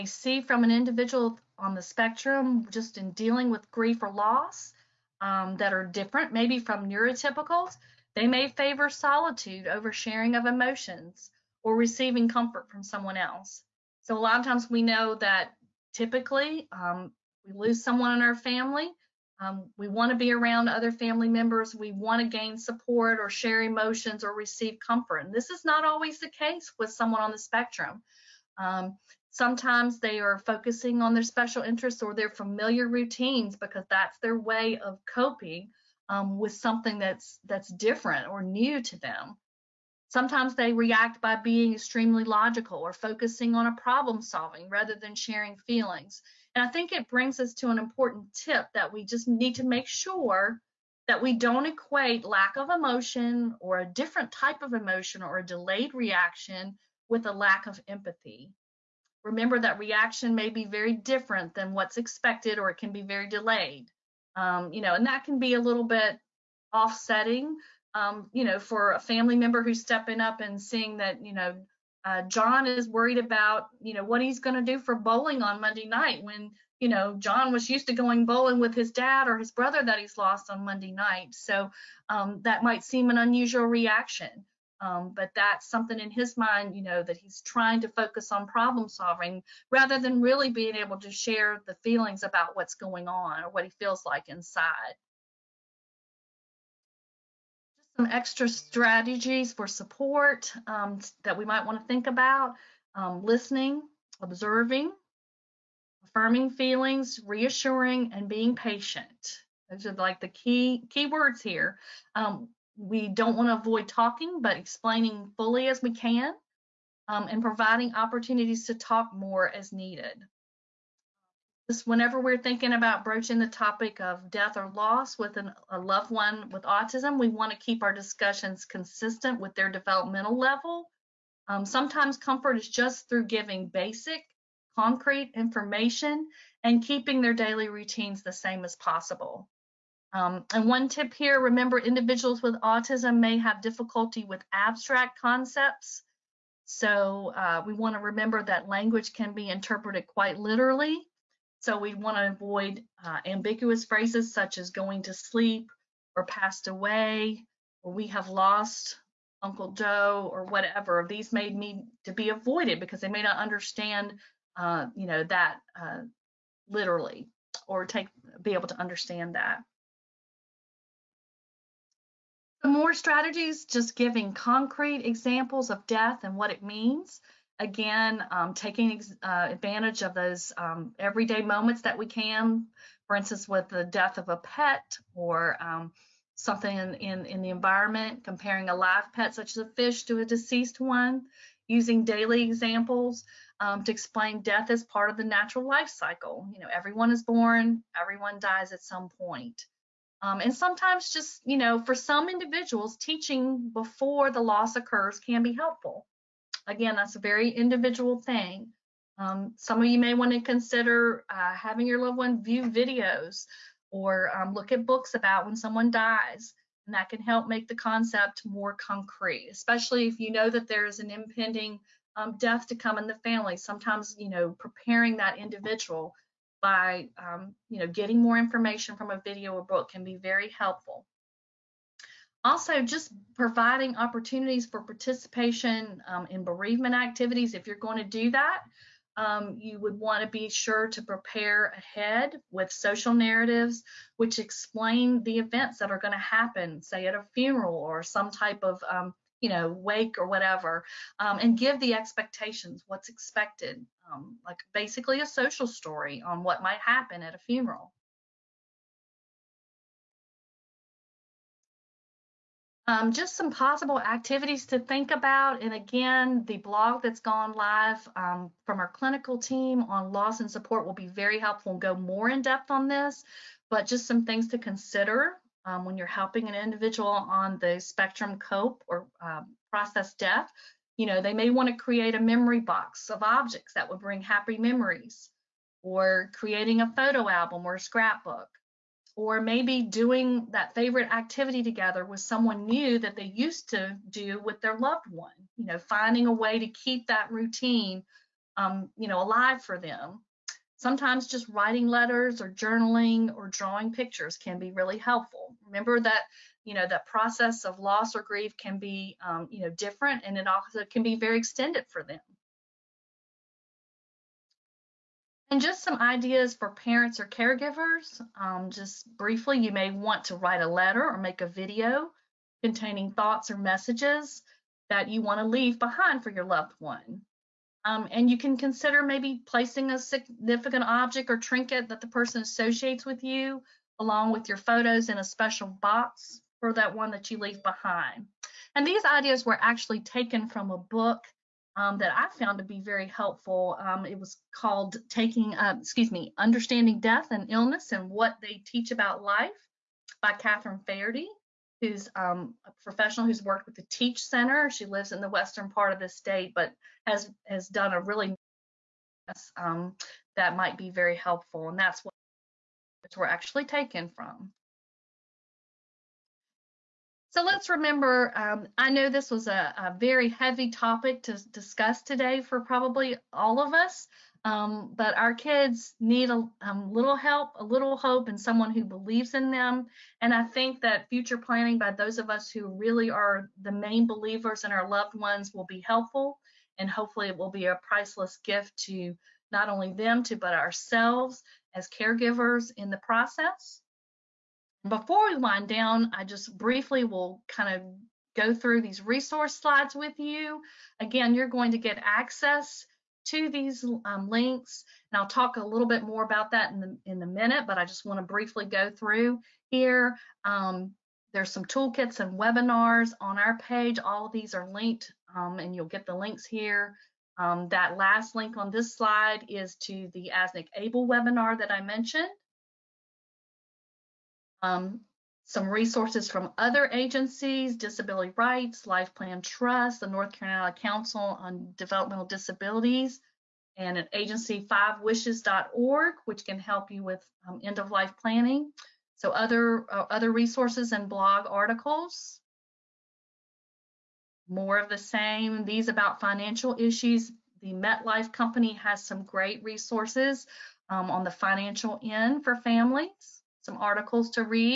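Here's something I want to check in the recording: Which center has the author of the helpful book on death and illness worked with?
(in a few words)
TEACCH Center.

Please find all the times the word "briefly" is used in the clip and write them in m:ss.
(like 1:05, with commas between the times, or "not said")
5:19, 6:36, 6:48.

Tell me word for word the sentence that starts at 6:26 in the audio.
And hopefully, it will be a priceless gift to not only them, to but ourselves as caregivers in the process.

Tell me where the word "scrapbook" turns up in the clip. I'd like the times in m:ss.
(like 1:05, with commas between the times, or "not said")
4:47.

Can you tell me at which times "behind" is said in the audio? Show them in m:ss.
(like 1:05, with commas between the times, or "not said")
5:25, 5:37.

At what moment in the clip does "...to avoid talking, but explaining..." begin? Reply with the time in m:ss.
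1:53.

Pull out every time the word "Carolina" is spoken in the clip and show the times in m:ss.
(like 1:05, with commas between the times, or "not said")
7:10.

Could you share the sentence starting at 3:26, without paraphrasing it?
Again, that's a very individual thing.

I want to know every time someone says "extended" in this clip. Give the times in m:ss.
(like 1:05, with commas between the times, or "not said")
5:11.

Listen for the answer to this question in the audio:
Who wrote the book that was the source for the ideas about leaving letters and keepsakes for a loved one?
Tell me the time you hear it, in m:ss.
5:50.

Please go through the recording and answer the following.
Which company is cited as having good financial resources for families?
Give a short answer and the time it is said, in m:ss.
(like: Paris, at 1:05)
MetLife, at 7:27.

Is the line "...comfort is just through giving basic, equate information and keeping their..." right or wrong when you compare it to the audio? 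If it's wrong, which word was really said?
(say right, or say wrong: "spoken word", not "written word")
wrong: "concrete", not "equate".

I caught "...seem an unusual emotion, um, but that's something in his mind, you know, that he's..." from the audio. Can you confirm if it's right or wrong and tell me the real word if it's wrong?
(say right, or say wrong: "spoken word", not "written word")
wrong: "reaction", not "emotion".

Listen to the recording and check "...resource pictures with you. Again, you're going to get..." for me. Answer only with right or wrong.
wrong.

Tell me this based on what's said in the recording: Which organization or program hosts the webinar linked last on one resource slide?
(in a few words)
ASNIC ABLE.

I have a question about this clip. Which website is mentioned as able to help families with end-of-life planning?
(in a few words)
fivewishes.org.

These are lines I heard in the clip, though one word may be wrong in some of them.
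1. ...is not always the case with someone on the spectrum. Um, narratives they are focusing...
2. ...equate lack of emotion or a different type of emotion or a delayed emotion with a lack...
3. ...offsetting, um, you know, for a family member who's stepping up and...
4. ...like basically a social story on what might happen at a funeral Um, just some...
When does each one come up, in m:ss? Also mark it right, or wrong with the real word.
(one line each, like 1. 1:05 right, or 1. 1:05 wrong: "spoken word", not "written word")
1. 0:25 wrong: "sometimes", not "narratives"
2. 0:51 wrong: "reaction", not "emotion"
3. 1:06 right
4. 4:14 right.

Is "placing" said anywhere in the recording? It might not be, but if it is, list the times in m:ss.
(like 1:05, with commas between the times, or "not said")
5:29.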